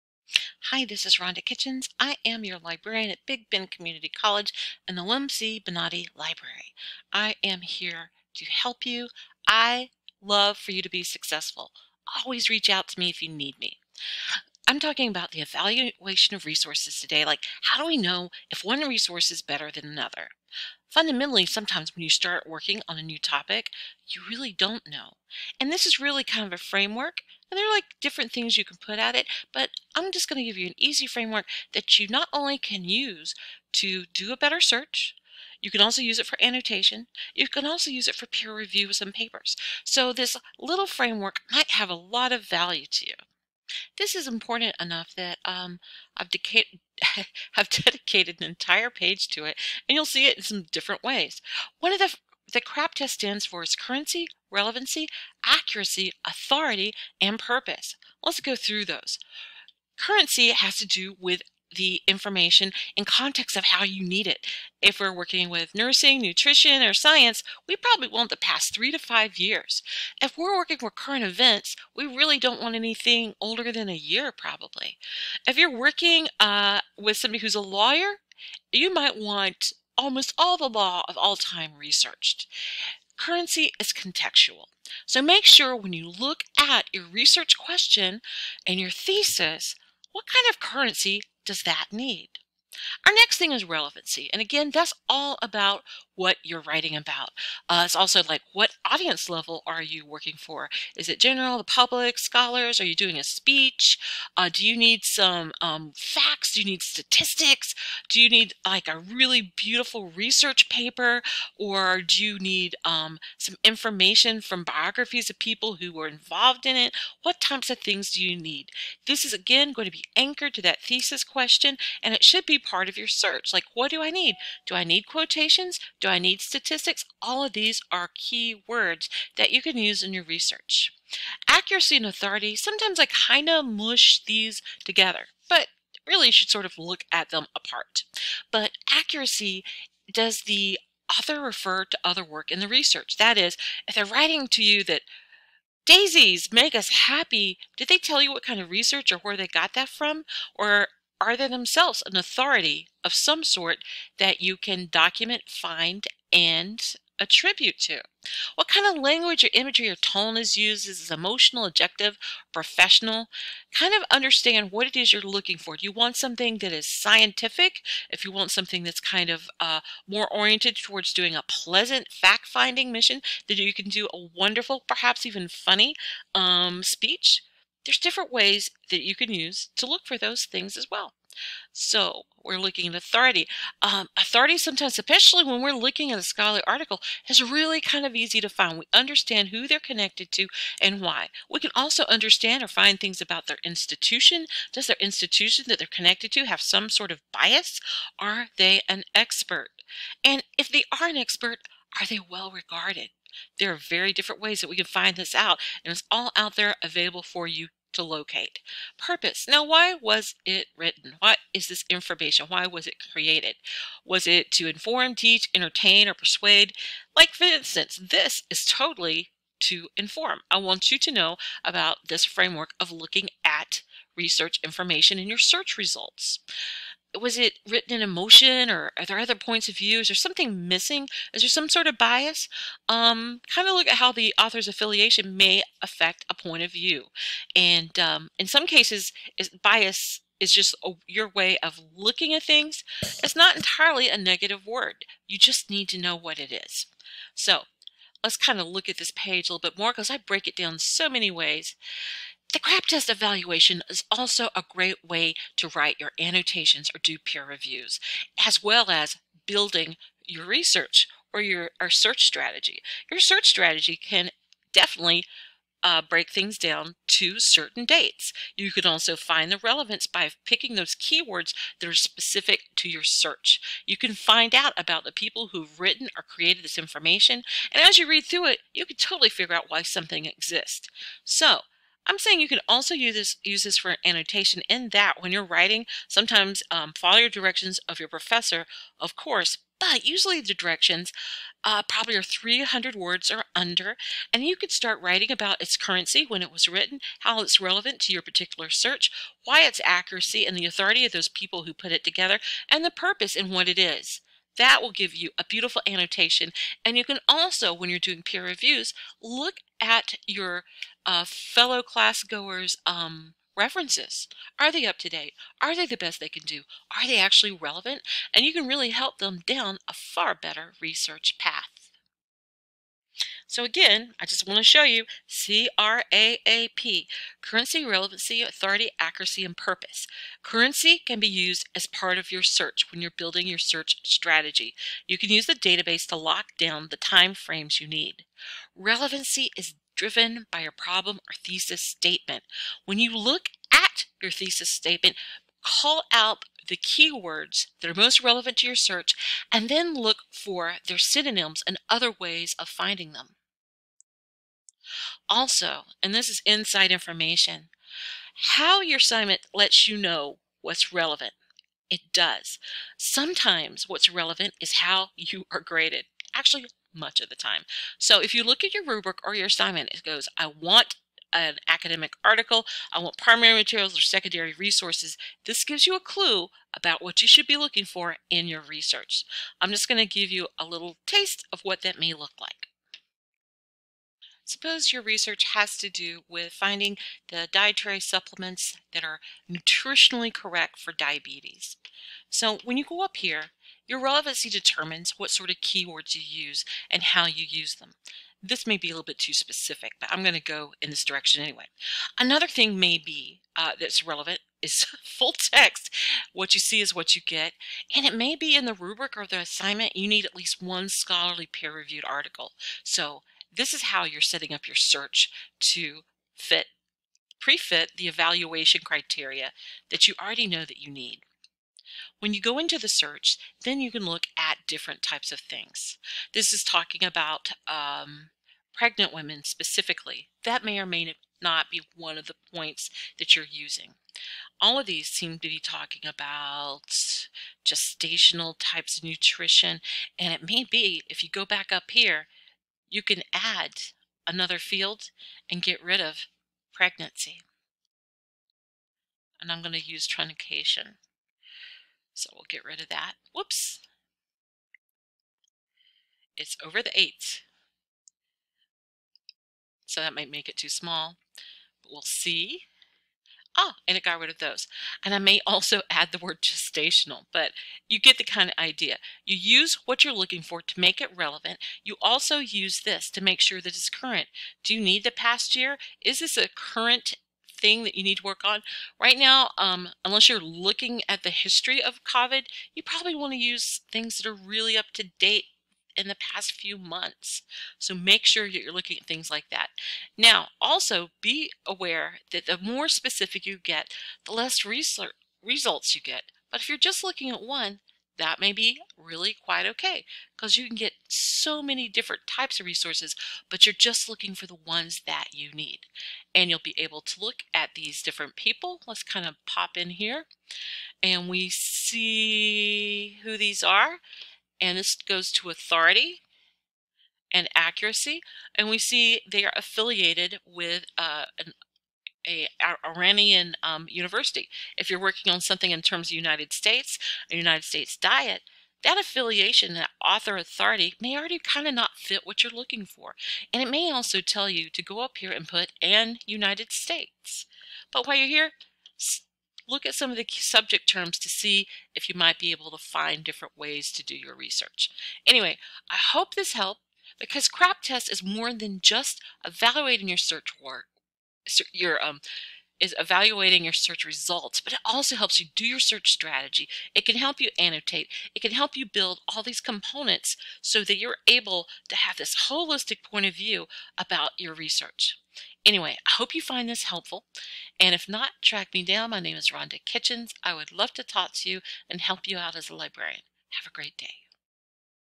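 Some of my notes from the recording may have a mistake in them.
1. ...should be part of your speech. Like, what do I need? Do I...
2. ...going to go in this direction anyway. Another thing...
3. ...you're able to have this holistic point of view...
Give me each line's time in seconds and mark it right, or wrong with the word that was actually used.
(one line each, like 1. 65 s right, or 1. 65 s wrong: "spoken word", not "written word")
1. 122 s wrong: "search", not "speech"
2. 400 s right
3. 560 s right.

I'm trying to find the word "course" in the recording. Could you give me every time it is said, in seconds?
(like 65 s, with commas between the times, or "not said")
289 s.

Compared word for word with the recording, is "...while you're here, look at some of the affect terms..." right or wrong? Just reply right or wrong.
wrong.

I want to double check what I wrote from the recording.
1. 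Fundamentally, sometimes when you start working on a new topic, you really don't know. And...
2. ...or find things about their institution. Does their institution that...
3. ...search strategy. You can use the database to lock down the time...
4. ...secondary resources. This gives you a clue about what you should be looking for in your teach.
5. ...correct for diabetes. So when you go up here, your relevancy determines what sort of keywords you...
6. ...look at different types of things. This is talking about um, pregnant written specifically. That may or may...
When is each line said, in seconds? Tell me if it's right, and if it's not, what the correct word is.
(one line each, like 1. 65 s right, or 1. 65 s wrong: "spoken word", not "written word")
1. 20 s right
2. 192 s right
3. 333 s right
4. 374 s wrong: "research", not "teach"
5. 390 s right
6. 424 s wrong: "women", not "written".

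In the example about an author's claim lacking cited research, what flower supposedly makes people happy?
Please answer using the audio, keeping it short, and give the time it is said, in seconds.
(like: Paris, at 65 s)
daisies, at 145 s.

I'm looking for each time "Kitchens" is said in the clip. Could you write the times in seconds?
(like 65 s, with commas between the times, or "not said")
1 s, 569 s.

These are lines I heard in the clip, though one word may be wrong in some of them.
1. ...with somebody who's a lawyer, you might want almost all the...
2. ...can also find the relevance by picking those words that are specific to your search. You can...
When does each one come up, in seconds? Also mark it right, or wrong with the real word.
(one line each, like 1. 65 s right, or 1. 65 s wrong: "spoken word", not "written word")
1. 76 s right
2. 268 s wrong: "keywords", not "words".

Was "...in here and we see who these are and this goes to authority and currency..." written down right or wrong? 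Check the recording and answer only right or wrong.
wrong.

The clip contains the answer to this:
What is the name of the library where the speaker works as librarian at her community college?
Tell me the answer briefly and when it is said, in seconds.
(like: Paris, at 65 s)
Lem C. Bonaudi Library, at 5 s.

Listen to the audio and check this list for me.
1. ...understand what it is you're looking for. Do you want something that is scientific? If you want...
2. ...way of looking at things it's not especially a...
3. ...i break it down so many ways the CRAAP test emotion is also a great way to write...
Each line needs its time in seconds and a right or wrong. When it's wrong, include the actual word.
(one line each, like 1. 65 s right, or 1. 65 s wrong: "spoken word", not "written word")
1. 164 s right
2. 241 s wrong: "entirely", not "especially"
3. 250 s wrong: "evaluation", not "emotion".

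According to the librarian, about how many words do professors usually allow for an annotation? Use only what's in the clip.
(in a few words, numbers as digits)
300.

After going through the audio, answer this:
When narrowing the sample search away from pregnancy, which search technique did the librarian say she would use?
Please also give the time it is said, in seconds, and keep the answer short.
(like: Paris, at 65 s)
truncation, at 450 s.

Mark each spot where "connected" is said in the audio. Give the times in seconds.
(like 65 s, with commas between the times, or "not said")
189 s, 195 s.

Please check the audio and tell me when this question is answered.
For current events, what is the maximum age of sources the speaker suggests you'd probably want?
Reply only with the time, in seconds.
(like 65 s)
73 s.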